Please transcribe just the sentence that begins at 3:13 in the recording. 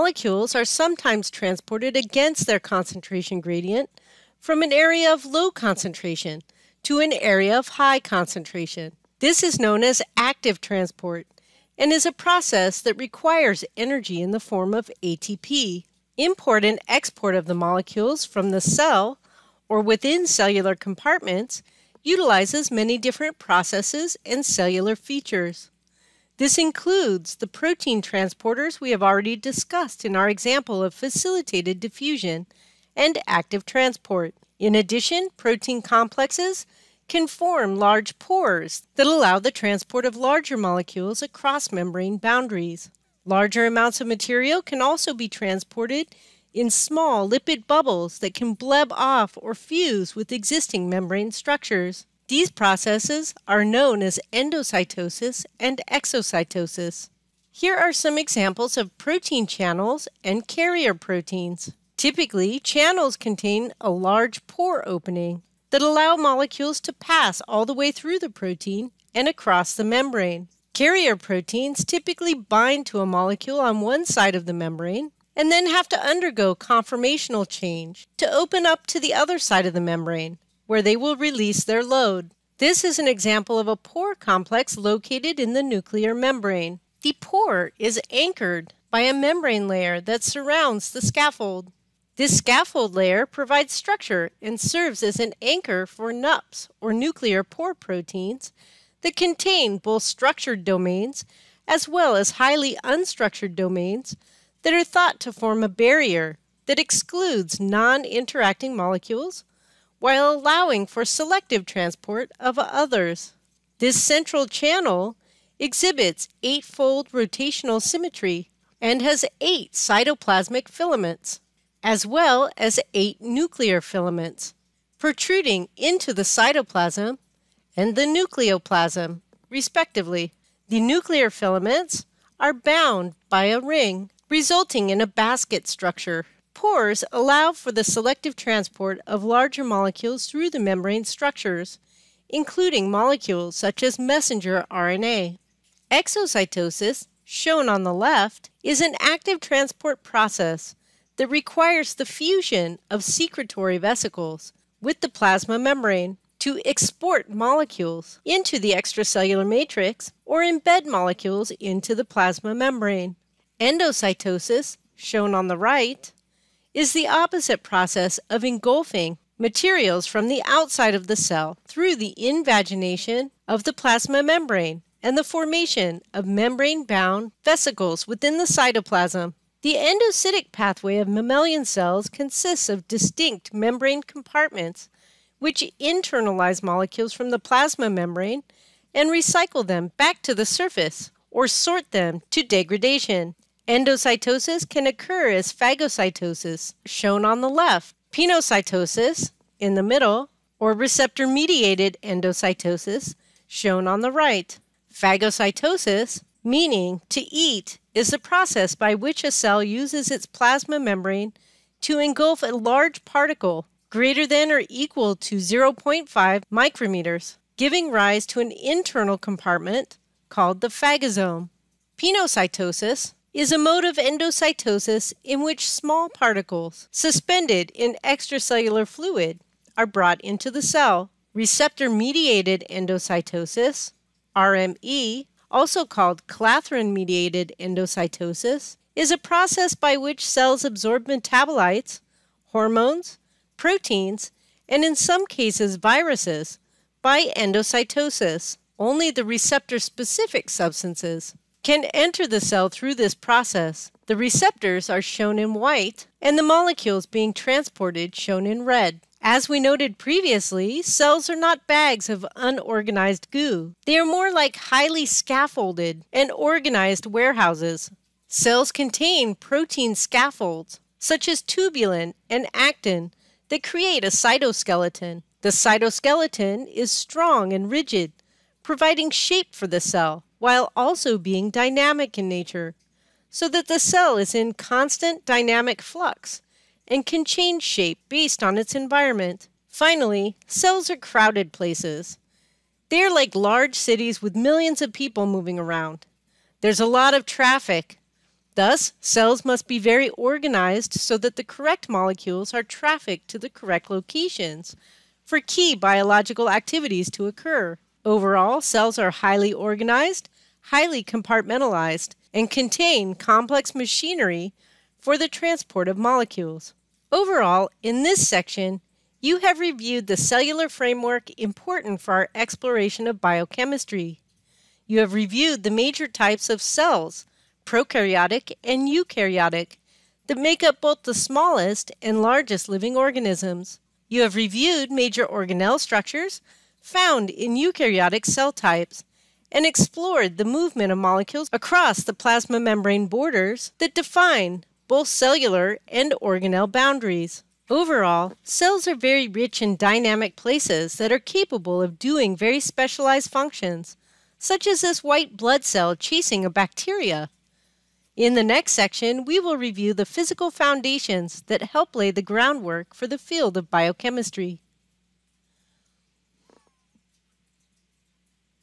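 Endocytosis can occur as phagocytosis, shown on the left, pinocytosis, in the middle, or receptor mediated endocytosis, shown on the right.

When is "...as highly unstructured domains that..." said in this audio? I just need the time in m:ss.
1:42.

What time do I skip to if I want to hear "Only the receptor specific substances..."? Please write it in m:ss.
4:08.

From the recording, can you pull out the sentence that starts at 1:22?
This is an example of a pore complex located in the nuclear membrane.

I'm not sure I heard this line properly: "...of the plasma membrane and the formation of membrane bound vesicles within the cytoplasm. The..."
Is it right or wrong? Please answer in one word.
right.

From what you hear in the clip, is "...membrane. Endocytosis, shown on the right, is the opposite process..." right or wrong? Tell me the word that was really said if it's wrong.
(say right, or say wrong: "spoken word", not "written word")
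right.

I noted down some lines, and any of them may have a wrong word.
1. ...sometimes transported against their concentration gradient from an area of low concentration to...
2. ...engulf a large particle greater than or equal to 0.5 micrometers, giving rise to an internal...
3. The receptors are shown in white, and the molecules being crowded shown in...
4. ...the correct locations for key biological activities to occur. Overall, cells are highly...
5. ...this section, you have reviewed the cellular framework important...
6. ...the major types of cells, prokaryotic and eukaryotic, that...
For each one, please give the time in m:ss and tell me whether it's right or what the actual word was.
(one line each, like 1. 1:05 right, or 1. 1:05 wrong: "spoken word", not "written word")
1. 0:00 right
2. 3:31 right
3. 4:14 wrong: "transported", not "crowded"
4. 5:03 right
5. 5:18 right
6. 5:25 right.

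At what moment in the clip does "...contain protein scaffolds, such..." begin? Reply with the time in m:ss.
4:28.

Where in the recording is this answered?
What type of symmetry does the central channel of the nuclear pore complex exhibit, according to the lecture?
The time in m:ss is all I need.
1:56.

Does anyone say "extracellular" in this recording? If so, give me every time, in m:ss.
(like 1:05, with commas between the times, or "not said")
2:38, 3:48.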